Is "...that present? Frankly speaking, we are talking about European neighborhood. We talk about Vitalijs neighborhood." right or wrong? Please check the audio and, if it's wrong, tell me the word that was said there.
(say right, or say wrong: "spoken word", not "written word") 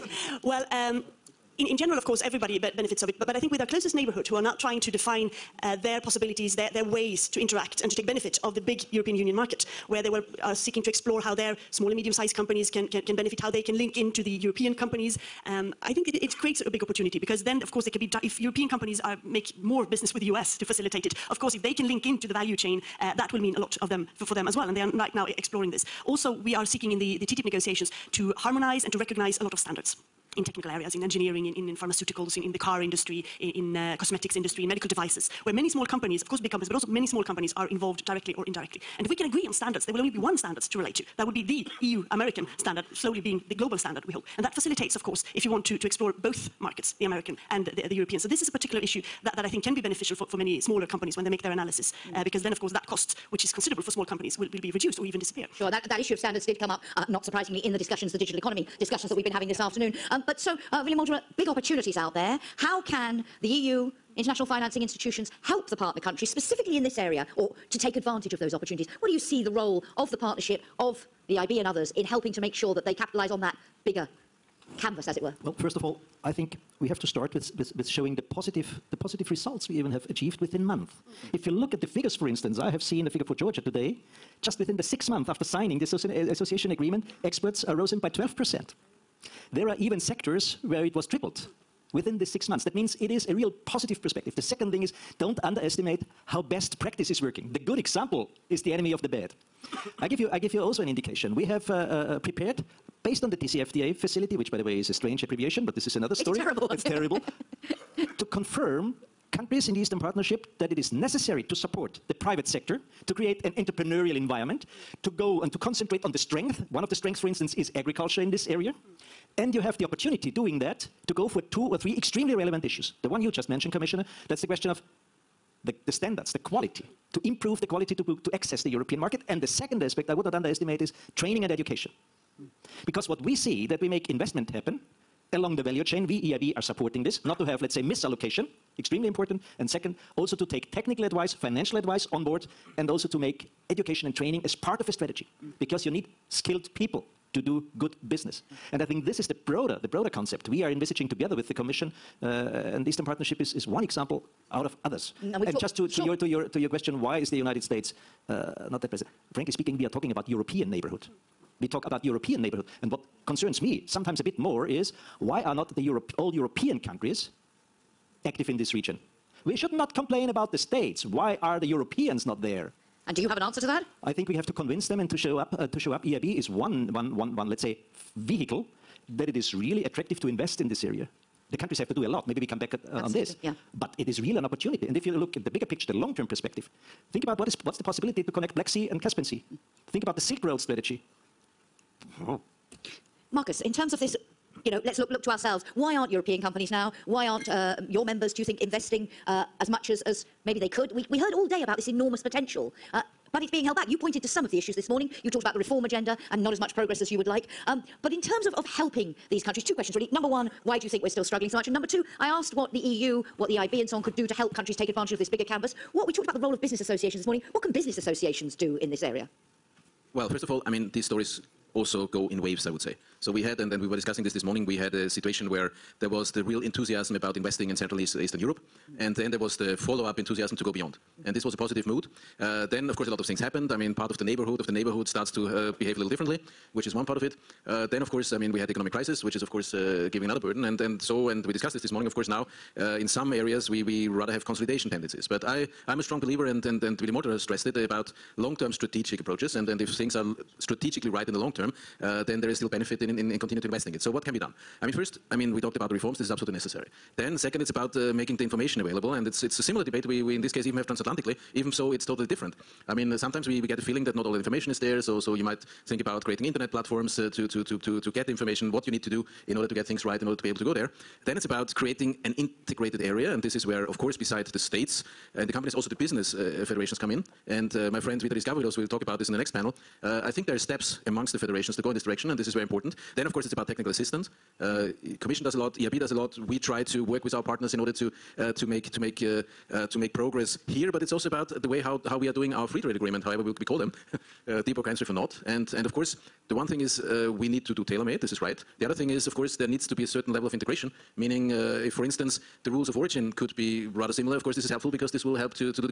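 wrong: "European", not "Vitalijs".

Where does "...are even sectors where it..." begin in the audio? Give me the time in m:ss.
1:29.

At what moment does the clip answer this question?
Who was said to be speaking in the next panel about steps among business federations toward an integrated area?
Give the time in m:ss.
4:38.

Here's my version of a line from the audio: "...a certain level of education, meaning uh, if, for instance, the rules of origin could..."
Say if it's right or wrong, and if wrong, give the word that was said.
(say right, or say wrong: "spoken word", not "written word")
wrong: "integration", not "education".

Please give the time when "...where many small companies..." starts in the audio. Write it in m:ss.
0:35.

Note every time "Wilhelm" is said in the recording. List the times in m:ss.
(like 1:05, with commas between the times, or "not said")
1:00.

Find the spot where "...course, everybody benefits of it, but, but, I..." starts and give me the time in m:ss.
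0:02.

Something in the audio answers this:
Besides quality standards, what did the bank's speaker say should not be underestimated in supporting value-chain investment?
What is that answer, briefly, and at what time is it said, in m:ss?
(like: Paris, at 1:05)
Training and education, at 2:11.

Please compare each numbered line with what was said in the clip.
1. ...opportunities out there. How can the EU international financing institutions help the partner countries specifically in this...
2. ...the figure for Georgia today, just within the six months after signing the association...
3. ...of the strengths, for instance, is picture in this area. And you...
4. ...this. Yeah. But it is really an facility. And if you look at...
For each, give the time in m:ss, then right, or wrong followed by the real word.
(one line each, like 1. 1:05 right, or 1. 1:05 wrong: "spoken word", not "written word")
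1. 1:01 right
2. 1:23 right
3. 1:56 wrong: "agriculture", not "picture"
4. 3:03 wrong: "opportunity", not "facility".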